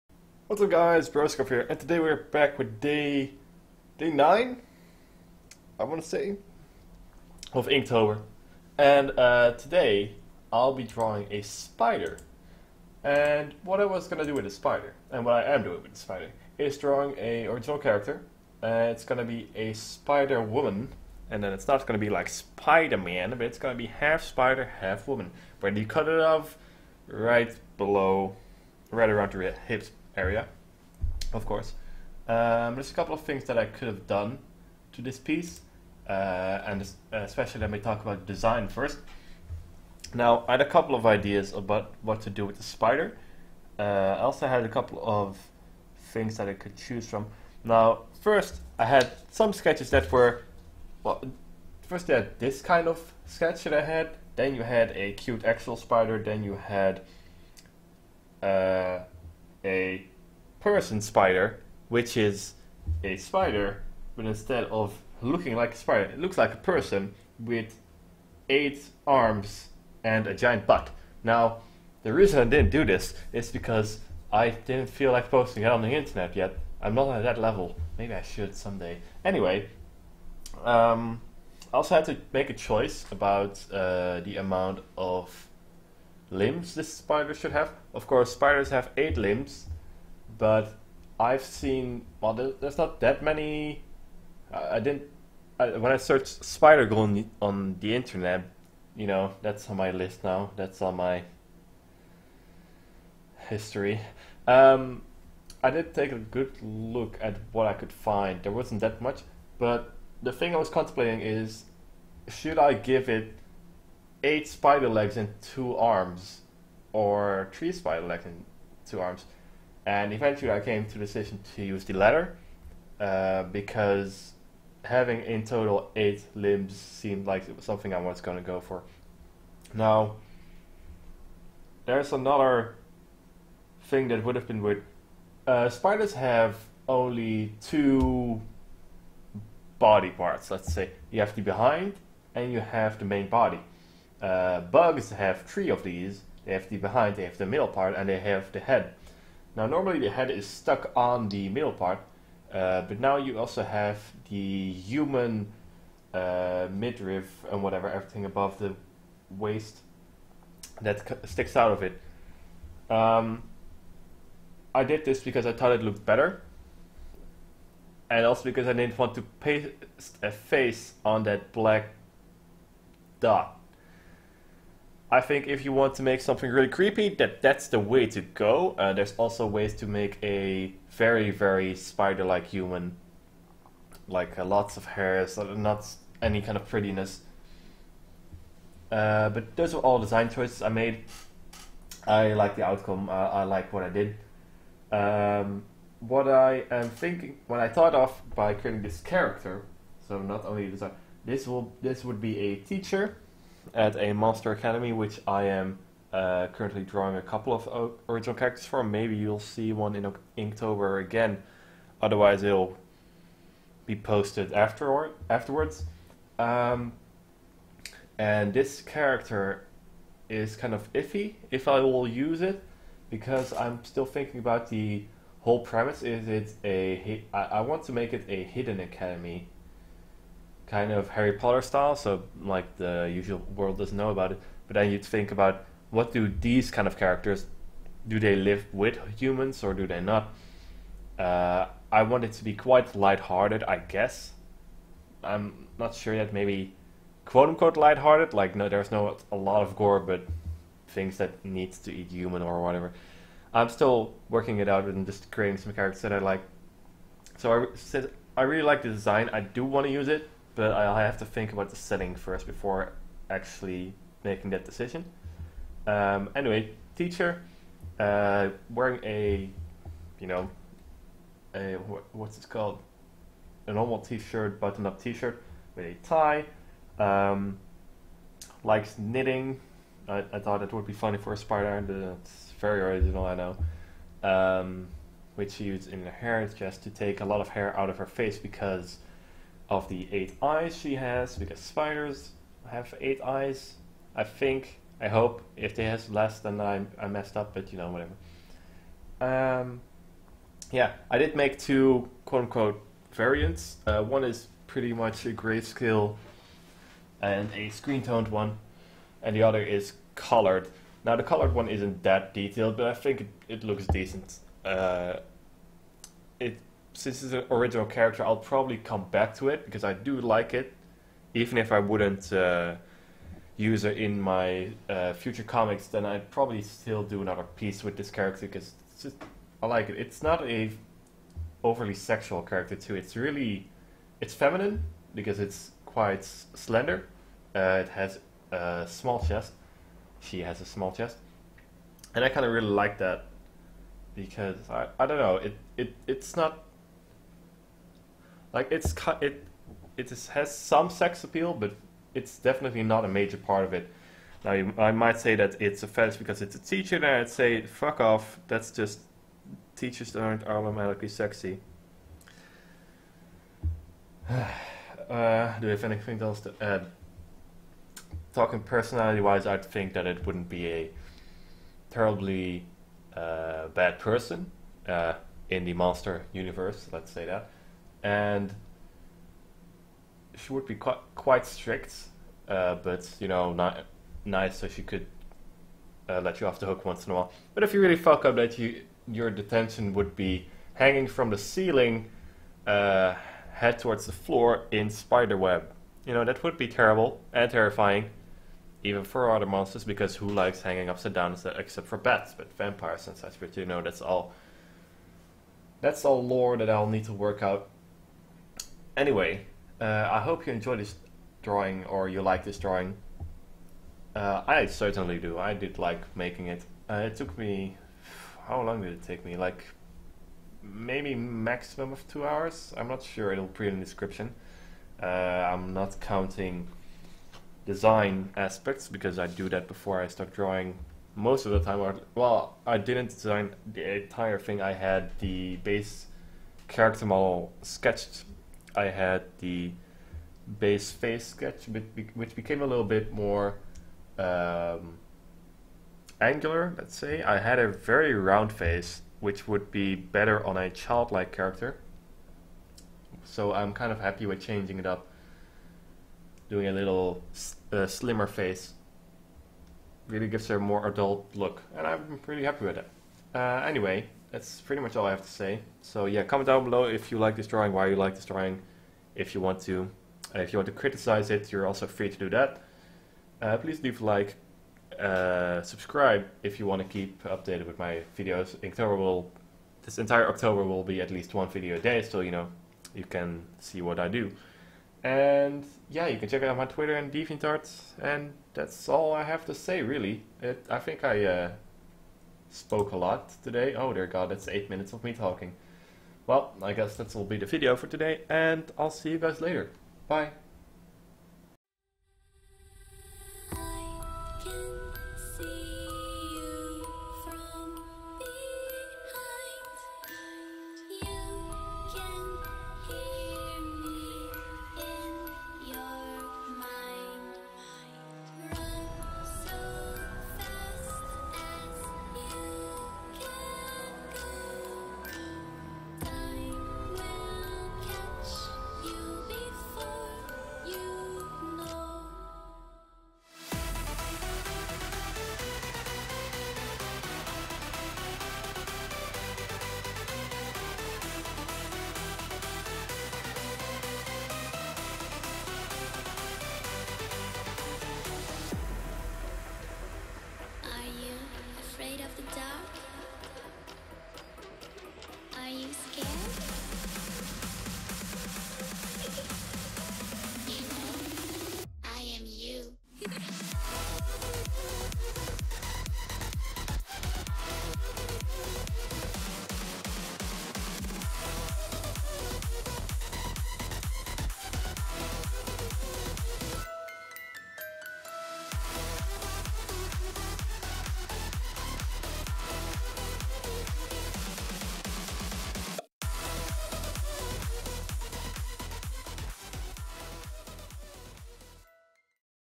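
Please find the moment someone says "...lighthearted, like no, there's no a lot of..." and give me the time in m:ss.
4:07.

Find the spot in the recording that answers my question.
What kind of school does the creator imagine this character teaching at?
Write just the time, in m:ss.
3:24.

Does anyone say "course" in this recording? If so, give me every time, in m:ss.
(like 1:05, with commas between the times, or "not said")
0:31, 1:28.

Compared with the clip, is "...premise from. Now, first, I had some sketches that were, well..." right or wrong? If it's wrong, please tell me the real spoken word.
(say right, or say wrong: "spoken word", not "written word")
wrong: "choose", not "premise".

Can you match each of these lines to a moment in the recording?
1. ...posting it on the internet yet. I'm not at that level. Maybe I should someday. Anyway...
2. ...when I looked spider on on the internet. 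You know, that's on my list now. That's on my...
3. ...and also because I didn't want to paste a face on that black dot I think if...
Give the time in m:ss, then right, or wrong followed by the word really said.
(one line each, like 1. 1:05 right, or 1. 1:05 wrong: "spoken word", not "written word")
1. 1:15 right
2. 1:35 wrong: "searched", not "looked"
3. 2:48 right.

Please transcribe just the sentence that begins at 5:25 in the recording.
Then I'd probably still do another piece with this character because just, I like it.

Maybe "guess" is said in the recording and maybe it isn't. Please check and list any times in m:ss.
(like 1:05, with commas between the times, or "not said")
4:03, 8:16.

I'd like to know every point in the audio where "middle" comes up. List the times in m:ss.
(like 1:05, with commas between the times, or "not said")
2:27, 2:31.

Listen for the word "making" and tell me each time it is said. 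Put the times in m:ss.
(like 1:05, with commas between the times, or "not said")
4:24, 6:56.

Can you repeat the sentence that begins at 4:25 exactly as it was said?
Um, anyway, teacher uh, wearing a, you know, a what's it called, a normal T-shirt, button-up T-shirt with a tie.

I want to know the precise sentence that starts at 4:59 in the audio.
Um, yeah, I did make two quote unquote variants.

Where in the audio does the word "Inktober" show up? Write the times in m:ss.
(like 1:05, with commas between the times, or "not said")
0:07, 3:30.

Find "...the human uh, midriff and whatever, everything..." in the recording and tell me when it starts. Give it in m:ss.
2:34.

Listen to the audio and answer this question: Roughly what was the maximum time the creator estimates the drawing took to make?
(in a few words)
2 hours.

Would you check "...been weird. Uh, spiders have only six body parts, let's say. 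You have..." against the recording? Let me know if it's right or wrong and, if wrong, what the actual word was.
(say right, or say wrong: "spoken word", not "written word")
wrong: "two", not "six".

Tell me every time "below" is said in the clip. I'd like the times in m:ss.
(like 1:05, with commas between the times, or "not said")
0:27, 7:46.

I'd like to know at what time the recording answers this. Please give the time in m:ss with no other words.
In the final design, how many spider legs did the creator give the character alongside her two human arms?
1:57.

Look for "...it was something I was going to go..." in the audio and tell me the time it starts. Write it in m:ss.
2:07.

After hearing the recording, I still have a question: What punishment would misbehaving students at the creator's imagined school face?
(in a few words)
Hanging from the ceiling.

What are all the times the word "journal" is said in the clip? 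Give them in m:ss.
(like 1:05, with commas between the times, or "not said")
not said.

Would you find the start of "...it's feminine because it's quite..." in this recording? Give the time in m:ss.
5:34.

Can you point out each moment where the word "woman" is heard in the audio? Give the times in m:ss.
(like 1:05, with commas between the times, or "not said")
0:20, 0:25.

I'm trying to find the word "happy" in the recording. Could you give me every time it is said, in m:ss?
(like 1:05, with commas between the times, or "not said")
7:33, 7:42.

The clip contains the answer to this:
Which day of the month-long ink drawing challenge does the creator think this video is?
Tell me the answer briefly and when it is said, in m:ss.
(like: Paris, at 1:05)
Day 9, at 0:03.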